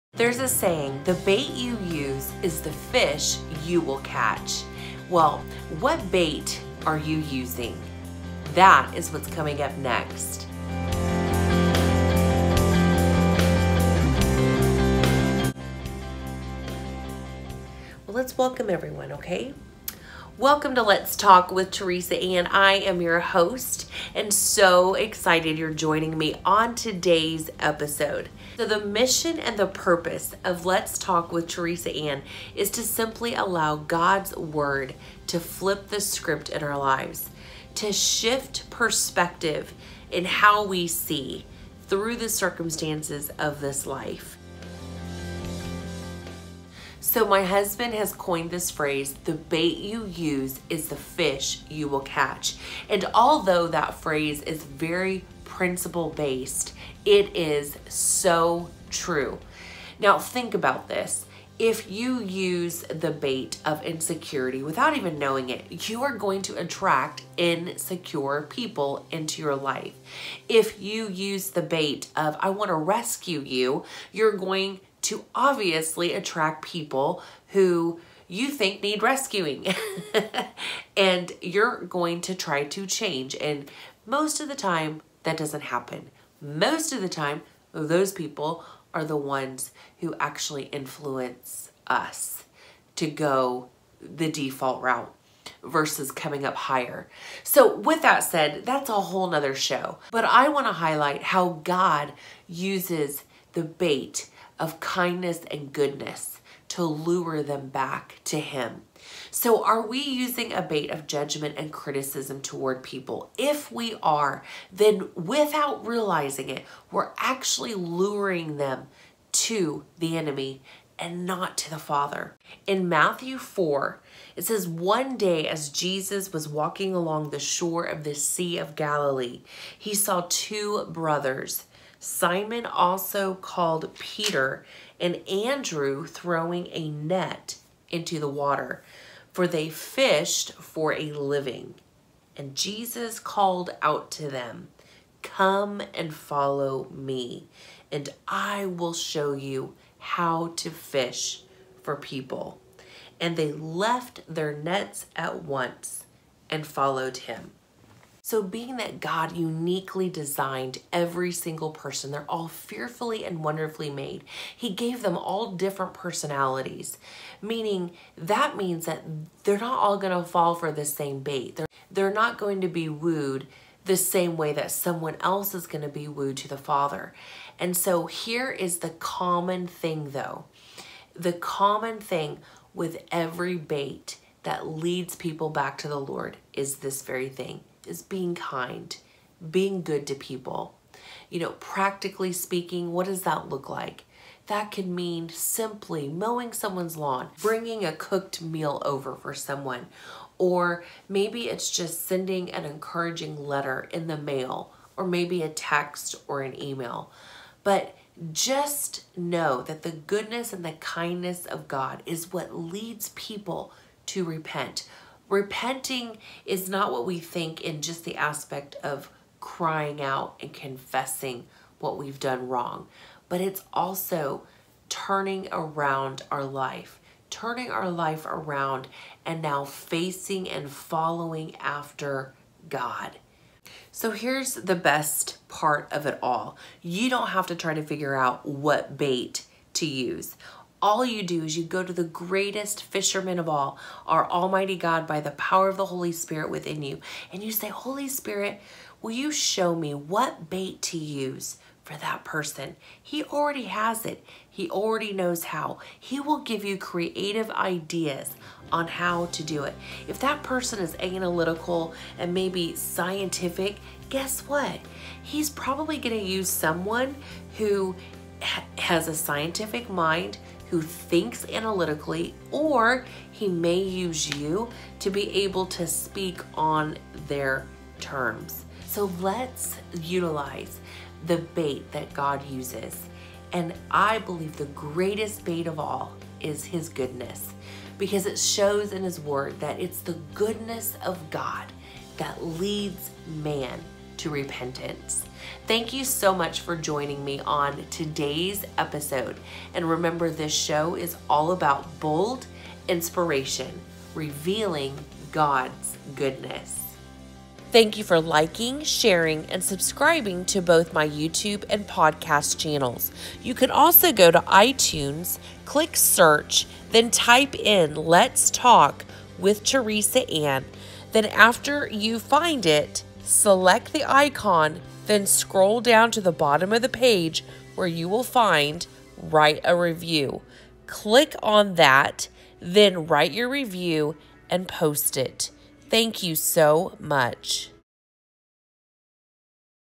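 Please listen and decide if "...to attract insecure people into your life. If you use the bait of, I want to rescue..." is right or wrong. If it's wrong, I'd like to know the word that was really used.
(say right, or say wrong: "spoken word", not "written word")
right.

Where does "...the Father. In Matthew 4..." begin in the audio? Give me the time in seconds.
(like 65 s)
121 s.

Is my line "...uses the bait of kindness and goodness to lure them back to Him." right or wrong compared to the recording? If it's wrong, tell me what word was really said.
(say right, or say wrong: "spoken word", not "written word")
right.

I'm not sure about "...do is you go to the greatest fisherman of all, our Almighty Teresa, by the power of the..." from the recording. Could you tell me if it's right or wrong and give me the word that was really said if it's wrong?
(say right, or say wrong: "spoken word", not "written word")
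wrong: "God", not "Teresa".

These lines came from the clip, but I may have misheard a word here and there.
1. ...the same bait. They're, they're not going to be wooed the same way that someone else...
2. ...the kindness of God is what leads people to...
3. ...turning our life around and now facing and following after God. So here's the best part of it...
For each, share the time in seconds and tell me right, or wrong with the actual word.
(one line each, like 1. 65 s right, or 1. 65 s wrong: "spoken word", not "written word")
1. 170 s right
2. 210 s right
3. 227 s right.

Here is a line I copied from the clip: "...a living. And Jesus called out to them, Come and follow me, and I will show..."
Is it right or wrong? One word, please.
right.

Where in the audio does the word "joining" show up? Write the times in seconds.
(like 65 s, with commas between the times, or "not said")
25 s, 296 s.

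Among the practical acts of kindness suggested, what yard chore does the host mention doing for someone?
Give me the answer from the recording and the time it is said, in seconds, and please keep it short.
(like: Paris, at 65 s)
Mowing someone's lawn, at 196 s.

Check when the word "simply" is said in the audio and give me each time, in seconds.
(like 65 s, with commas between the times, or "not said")
32 s, 195 s.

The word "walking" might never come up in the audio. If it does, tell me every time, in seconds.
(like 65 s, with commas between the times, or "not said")
126 s.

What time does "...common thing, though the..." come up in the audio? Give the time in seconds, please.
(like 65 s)
178 s.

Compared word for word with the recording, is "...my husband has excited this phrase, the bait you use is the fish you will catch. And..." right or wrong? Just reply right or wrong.
wrong.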